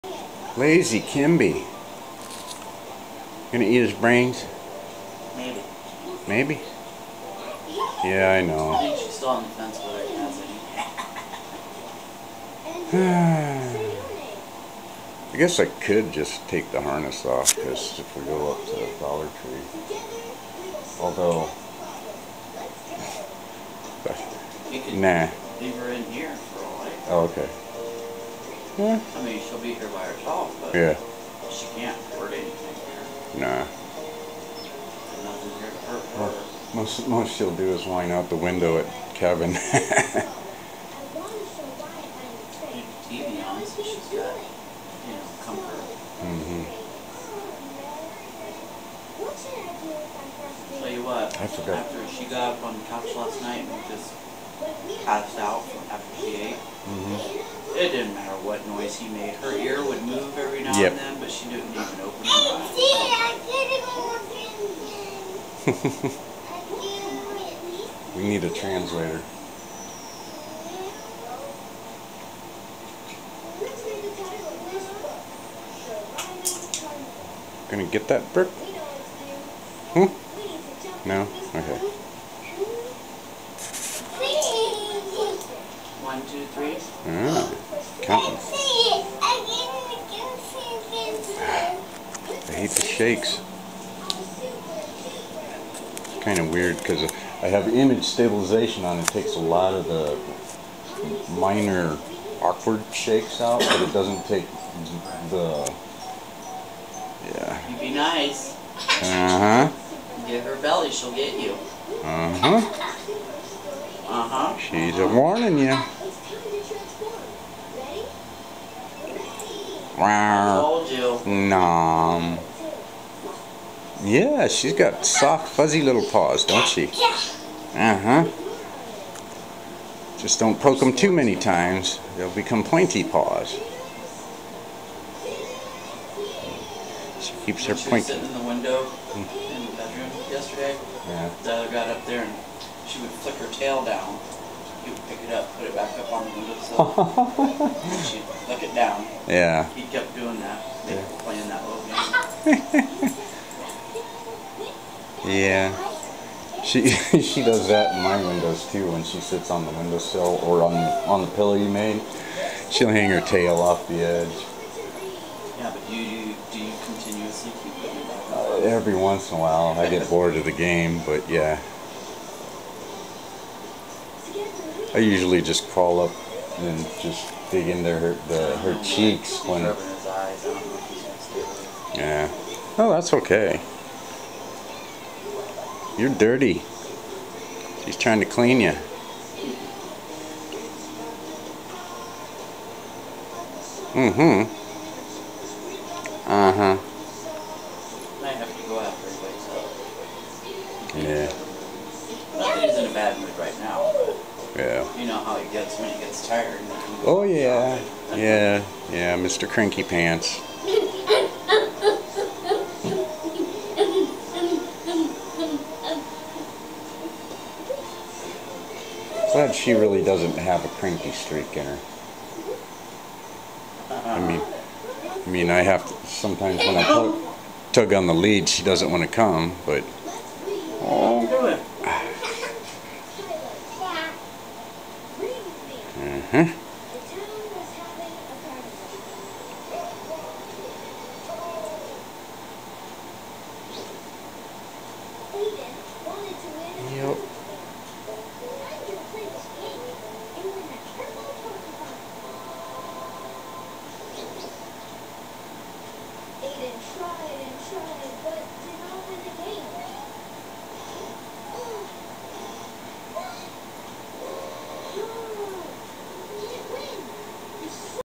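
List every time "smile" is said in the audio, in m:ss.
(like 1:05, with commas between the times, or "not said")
not said.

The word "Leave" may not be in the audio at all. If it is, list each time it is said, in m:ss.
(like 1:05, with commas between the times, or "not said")
0:25.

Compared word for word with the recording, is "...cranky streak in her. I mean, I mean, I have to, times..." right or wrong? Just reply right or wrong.
wrong.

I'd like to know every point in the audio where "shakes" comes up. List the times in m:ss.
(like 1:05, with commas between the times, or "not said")
1:32, 1:42.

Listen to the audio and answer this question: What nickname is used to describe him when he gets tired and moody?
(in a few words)
Mr. Cranky Pants.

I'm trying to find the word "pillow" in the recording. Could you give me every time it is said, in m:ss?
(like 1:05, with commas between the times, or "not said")
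2:41.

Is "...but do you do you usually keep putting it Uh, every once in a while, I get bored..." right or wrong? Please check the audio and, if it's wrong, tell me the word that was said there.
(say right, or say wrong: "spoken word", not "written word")
wrong: "continuously", not "usually".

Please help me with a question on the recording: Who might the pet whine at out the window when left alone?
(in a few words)
Kevin.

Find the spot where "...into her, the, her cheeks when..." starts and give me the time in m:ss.
2:57.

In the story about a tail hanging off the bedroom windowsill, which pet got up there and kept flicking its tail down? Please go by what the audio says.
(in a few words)
Della.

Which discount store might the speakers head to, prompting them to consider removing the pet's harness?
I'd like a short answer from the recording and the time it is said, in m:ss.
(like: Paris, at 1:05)
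Dollar Tree, at 0:18.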